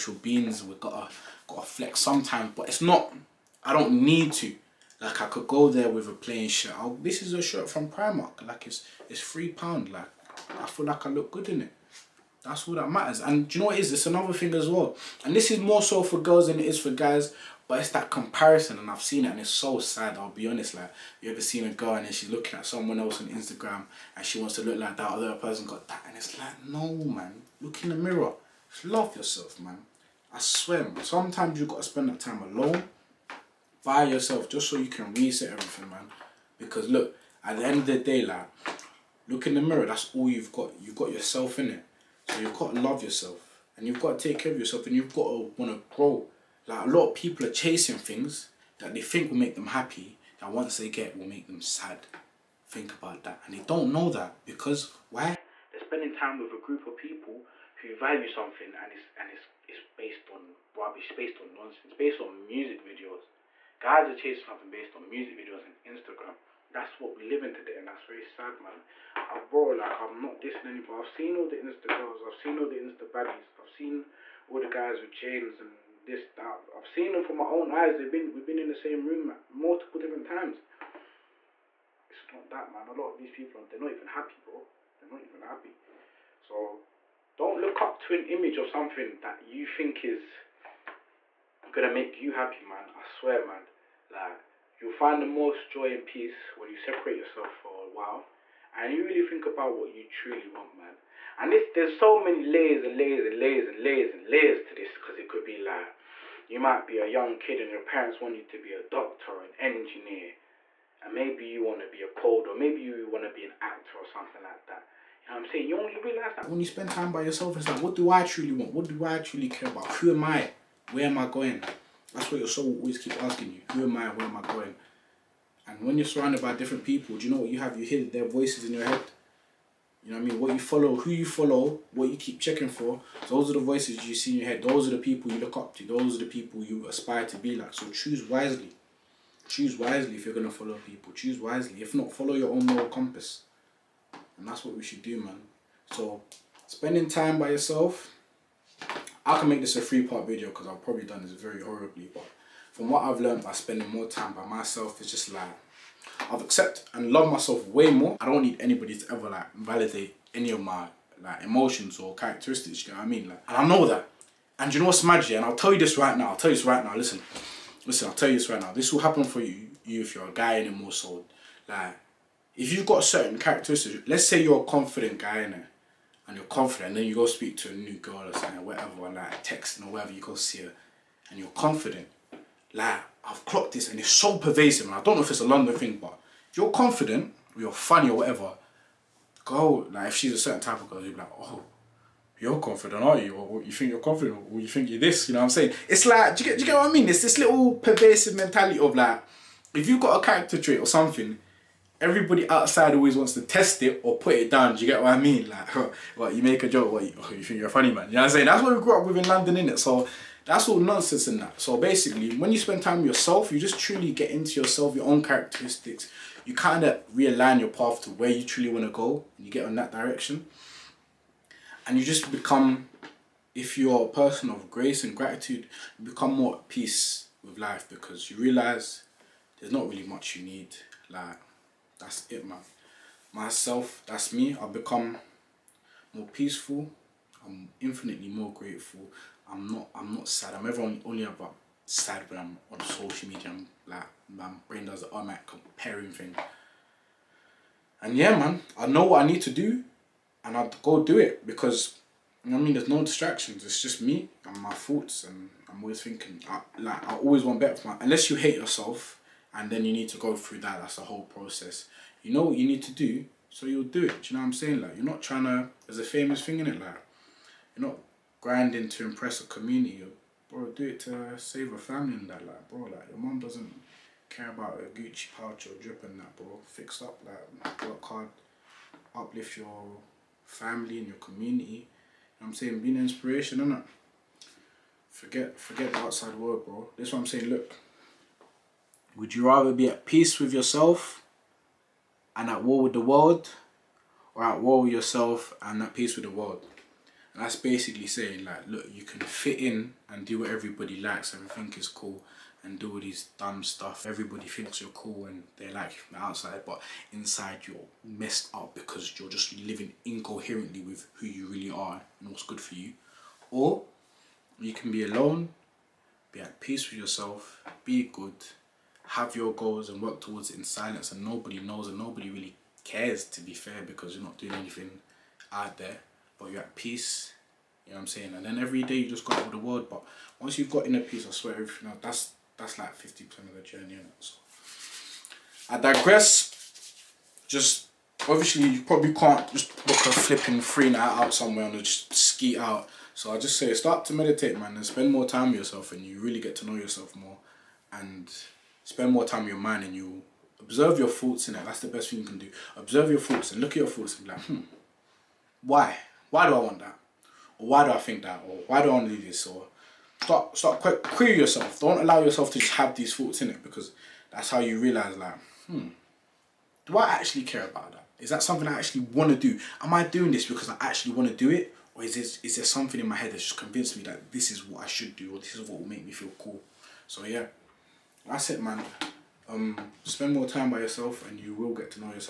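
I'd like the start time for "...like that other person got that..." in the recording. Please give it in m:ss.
0:24.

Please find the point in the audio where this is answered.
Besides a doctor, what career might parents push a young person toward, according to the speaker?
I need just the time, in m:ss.
1:49.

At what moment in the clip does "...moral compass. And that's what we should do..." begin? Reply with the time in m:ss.
2:22.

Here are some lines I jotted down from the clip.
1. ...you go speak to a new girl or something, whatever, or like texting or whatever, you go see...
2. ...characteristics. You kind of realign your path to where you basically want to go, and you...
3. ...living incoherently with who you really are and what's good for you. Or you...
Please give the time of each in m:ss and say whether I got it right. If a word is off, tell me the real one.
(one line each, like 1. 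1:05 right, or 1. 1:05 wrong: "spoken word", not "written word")
1. 2:57 right
2. 3:35 wrong: "truly", not "basically"
3. 5:09 right.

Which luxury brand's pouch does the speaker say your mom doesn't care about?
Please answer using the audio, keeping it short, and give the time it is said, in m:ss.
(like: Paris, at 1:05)
Gucci, at 4:34.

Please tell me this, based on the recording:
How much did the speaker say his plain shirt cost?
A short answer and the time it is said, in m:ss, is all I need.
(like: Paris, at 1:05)
3 pounds, at 0:09.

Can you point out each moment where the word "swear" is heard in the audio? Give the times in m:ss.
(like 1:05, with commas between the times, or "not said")
0:30, 1:33, 5:31.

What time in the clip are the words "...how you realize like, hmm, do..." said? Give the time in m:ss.
6:04.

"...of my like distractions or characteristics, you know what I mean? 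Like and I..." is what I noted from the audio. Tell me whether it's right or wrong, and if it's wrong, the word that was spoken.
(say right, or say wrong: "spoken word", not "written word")
wrong: "emotions", not "distractions".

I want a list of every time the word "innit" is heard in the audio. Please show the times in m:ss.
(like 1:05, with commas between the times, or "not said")
3:29, 4:43.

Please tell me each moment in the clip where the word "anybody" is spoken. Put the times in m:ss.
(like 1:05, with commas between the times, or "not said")
1:10, 2:38.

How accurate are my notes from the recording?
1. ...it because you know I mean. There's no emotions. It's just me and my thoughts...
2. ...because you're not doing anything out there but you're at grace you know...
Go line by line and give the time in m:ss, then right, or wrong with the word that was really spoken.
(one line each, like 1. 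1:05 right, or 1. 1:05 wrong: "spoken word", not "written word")
1. 4:11 wrong: "distractions", not "emotions"
2. 5:23 wrong: "peace", not "grace".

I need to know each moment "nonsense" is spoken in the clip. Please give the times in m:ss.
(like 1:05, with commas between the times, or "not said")
1:01, 3:30.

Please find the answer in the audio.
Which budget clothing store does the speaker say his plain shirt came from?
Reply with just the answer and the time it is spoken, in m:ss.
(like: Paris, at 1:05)
Primark, at 0:07.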